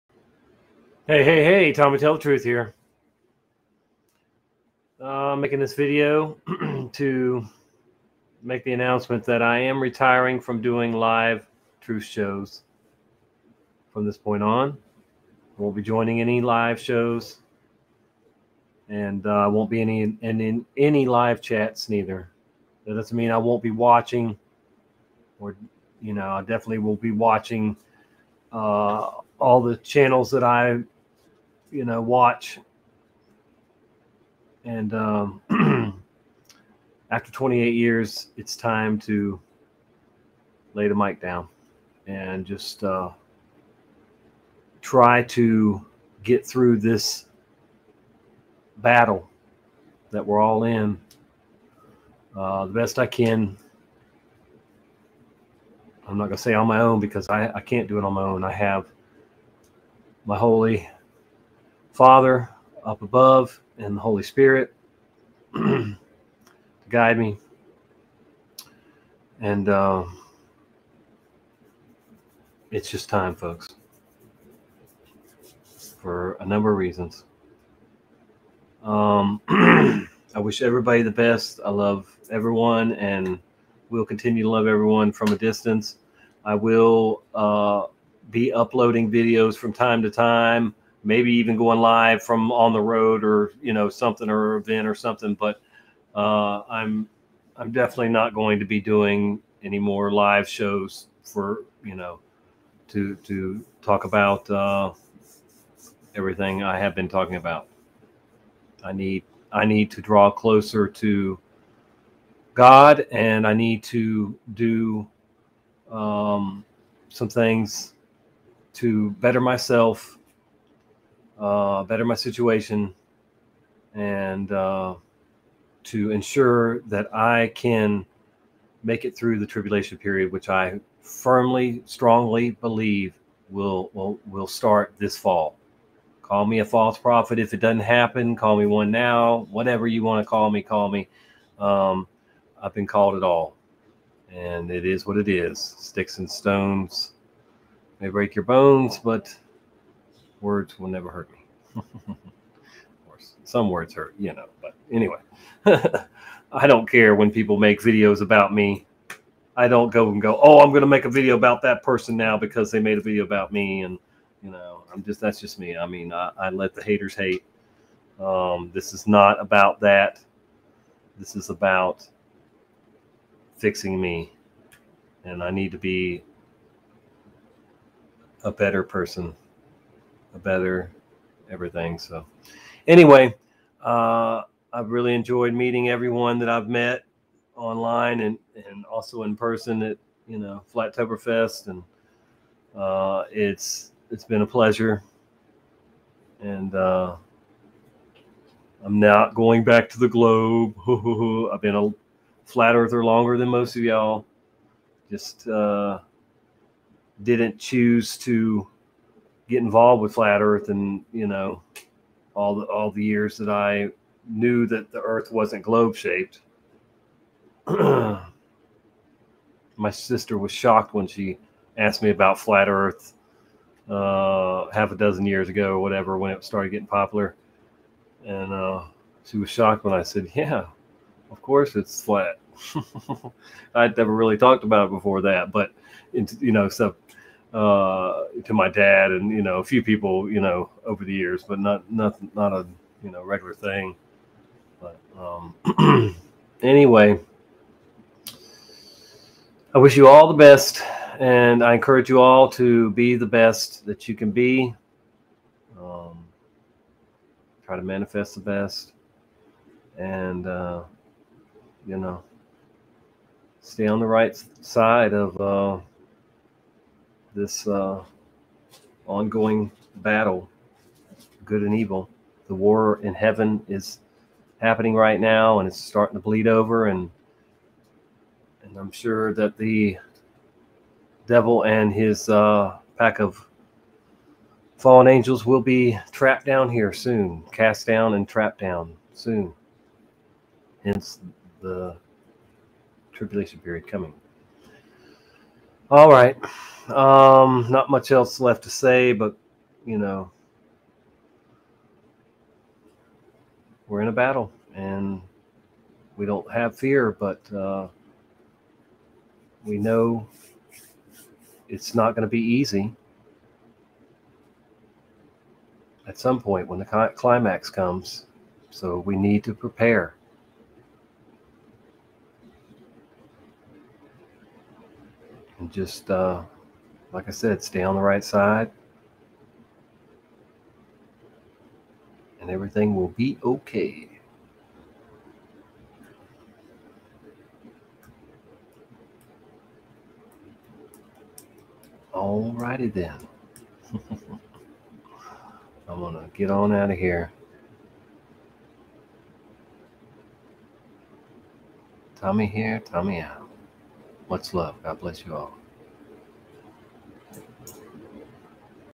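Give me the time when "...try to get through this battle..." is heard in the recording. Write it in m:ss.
0:44.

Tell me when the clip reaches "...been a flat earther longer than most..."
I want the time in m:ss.
3:21.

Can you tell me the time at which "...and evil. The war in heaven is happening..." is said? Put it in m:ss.
4:31.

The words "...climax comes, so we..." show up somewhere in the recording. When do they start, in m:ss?
5:17.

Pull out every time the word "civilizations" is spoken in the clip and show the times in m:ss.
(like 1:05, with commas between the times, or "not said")
not said.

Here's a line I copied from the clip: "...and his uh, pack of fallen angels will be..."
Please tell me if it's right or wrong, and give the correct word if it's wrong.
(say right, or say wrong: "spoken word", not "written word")
right.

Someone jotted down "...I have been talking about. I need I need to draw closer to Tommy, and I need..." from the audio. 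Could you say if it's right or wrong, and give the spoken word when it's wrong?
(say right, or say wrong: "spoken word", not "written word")
wrong: "God", not "Tommy".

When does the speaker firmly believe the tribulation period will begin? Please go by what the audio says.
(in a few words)
this fall.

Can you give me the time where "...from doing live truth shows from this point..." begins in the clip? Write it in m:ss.
0:10.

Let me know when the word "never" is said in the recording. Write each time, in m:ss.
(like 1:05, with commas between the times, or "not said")
2:30, 3:53.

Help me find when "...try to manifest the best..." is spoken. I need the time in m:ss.
4:17.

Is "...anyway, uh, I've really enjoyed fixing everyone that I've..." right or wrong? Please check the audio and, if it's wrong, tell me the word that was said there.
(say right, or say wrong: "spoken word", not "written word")
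wrong: "meeting", not "fixing".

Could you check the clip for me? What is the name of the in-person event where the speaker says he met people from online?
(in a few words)
Flattoberfest.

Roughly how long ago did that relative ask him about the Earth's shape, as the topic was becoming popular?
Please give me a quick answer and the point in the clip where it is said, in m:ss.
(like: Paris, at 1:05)
half a dozen years, at 3:44.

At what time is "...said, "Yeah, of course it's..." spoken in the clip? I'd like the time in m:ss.
3:50.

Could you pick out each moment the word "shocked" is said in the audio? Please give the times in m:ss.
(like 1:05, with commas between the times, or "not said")
3:40, 3:49.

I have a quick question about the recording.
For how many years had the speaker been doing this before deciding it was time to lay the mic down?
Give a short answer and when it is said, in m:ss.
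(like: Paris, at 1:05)
28, at 0:37.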